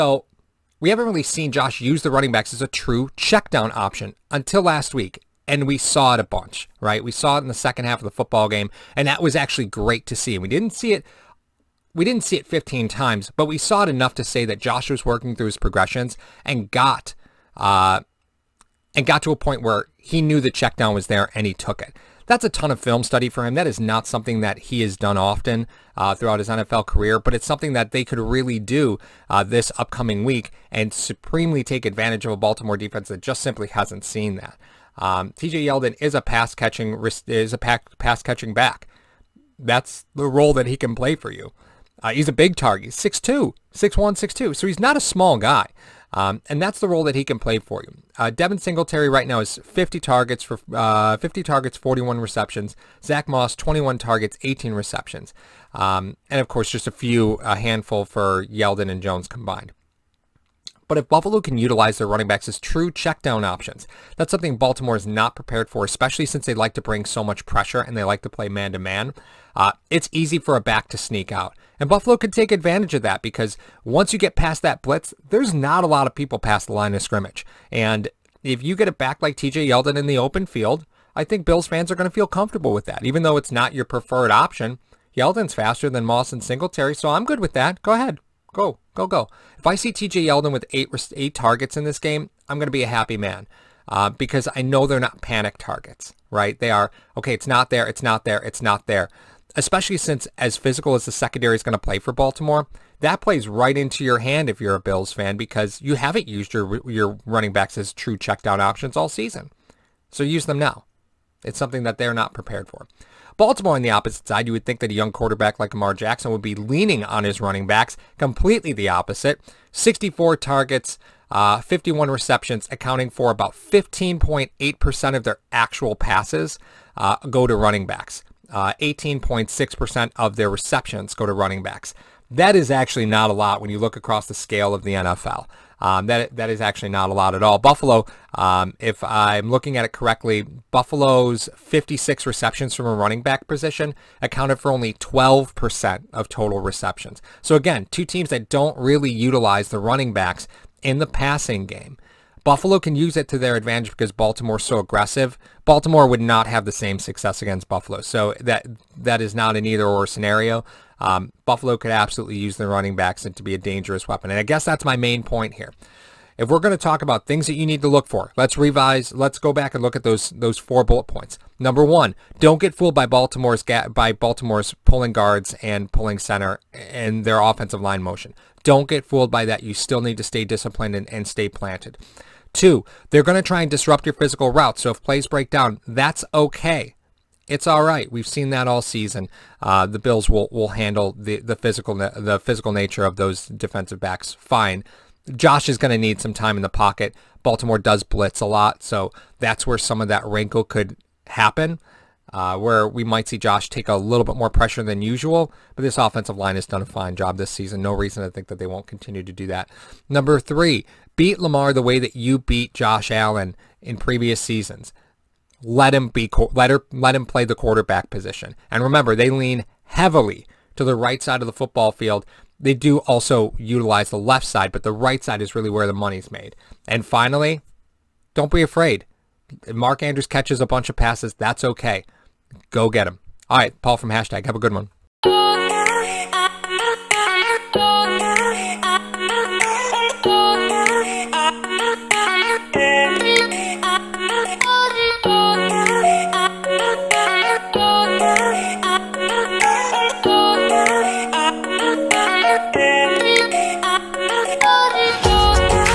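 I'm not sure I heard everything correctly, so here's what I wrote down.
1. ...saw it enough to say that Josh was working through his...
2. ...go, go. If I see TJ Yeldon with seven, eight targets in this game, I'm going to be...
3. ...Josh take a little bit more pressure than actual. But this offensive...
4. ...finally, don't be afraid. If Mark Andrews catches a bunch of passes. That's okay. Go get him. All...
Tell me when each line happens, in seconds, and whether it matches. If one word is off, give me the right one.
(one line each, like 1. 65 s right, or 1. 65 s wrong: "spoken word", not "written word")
1. 13 s right
2. 89 s wrong: "eight", not "seven"
3. 203 s wrong: "usual", not "actual"
4. 227 s right.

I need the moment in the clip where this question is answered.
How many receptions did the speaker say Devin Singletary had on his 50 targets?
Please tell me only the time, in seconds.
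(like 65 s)
51 s.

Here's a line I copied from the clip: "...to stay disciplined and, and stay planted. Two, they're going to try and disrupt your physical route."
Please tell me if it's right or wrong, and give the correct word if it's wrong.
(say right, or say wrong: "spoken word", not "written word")
right.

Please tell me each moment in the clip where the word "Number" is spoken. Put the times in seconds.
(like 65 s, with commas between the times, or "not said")
171 s, 210 s.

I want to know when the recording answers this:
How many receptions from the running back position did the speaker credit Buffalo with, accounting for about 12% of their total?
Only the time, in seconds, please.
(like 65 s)
141 s.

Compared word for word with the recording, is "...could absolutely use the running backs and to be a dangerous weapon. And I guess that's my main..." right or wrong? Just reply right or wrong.
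right.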